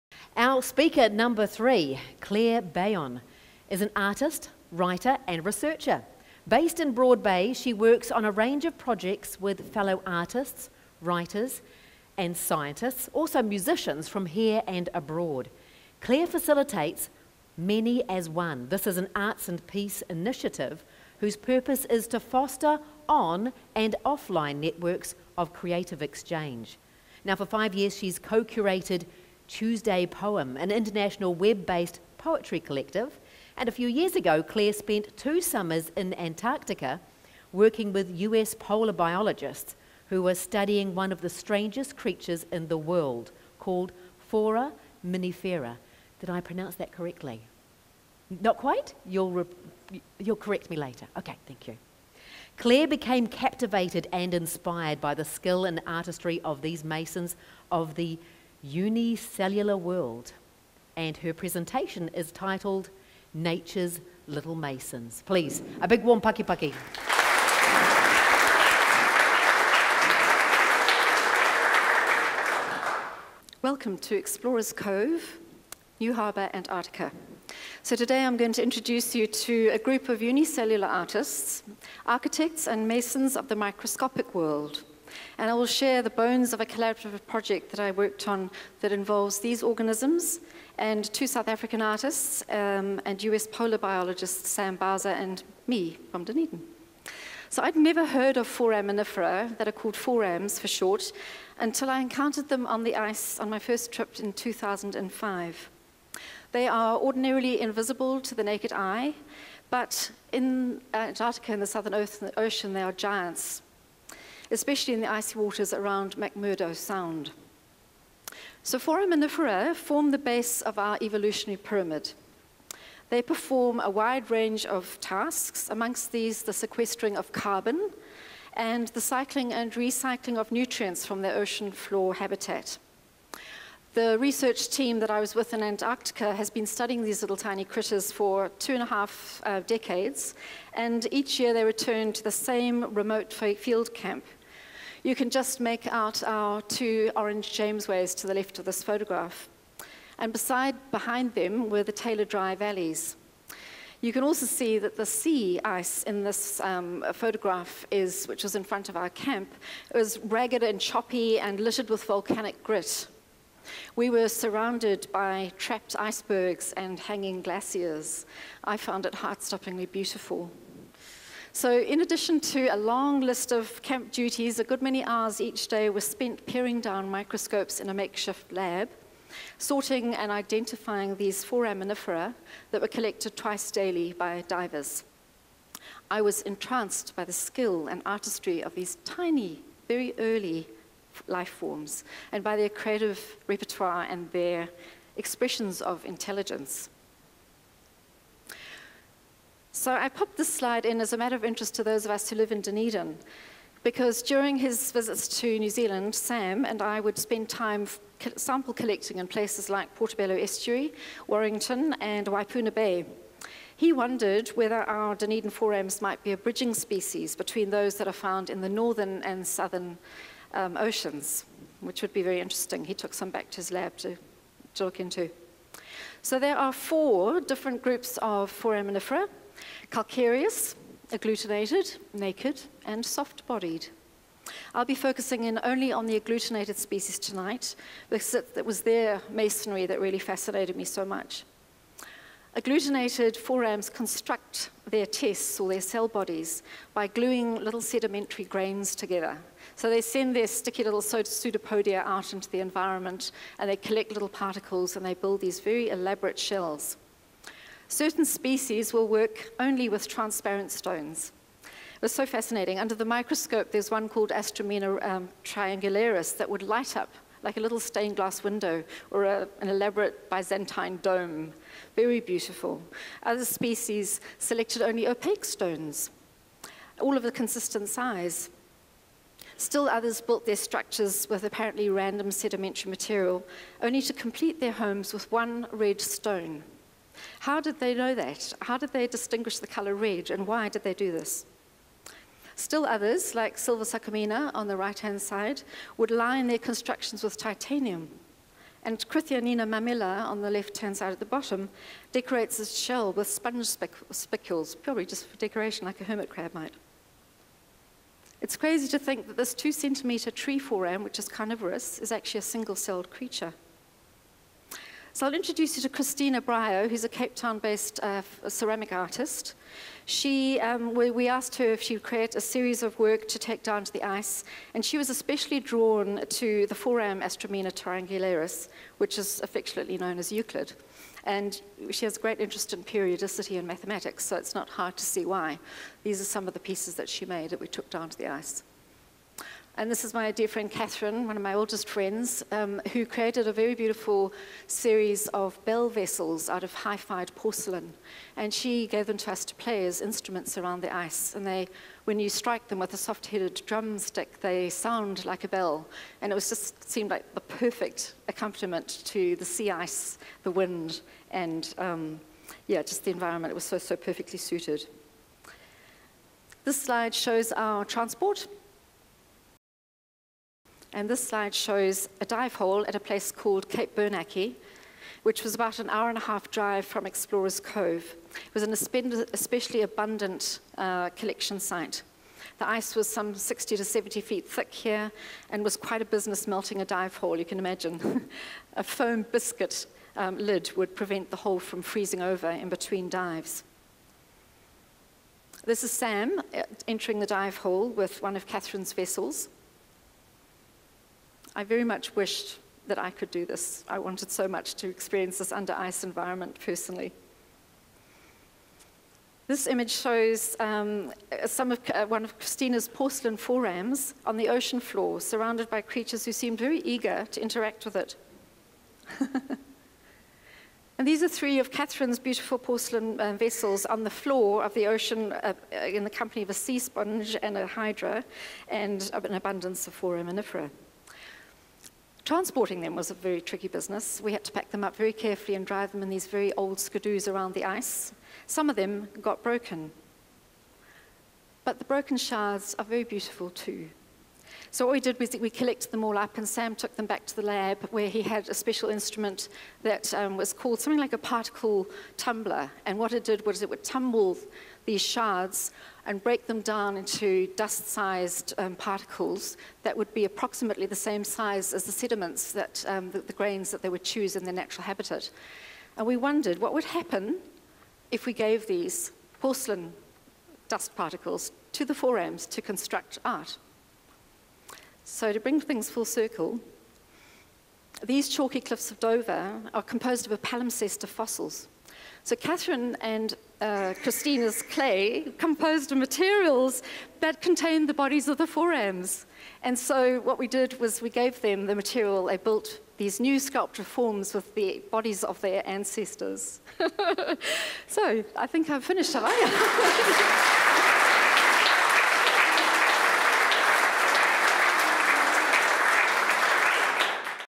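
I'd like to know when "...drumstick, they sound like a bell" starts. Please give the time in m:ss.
5:53.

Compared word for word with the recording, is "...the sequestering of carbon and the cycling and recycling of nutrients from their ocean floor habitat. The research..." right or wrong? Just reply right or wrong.
right.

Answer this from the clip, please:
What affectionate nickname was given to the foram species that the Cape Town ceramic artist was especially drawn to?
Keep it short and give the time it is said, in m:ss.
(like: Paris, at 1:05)
Euclid, at 5:30.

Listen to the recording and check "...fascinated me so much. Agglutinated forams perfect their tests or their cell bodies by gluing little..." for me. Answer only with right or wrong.
wrong.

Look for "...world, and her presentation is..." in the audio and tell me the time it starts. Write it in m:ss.
0:59.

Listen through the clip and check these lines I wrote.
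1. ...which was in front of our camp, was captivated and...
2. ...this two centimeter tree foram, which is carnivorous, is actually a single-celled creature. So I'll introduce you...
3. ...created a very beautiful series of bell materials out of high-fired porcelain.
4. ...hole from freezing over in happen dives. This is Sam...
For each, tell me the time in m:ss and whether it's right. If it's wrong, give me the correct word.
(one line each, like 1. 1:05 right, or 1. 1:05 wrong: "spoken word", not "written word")
1. 2:38 wrong: "ragged", not "captivated"
2. 5:09 right
3. 5:43 wrong: "vessels", not "materials"
4. 6:31 wrong: "between", not "happen".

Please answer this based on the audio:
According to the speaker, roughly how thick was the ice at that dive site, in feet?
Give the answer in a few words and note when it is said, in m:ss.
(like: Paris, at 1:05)
60 to 70 feet, at 6:23.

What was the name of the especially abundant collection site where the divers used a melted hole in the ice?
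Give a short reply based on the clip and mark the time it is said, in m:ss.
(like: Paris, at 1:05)
Cape Bernacchi, at 6:13.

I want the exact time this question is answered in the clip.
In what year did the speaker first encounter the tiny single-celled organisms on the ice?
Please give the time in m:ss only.
1:44.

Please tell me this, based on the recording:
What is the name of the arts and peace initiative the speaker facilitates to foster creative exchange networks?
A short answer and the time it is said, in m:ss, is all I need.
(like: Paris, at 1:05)
Many as One, at 0:17.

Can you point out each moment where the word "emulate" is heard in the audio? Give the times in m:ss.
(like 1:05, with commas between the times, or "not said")
not said.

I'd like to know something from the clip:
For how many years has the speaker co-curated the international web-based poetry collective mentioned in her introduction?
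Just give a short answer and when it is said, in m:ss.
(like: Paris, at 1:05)
5, at 0:27.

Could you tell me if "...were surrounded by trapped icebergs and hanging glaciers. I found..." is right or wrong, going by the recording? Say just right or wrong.
right.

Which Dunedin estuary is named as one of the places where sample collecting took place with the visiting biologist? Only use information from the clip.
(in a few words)
Portobello Estuary.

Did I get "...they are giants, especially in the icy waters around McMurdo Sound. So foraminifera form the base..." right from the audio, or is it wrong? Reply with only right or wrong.
right.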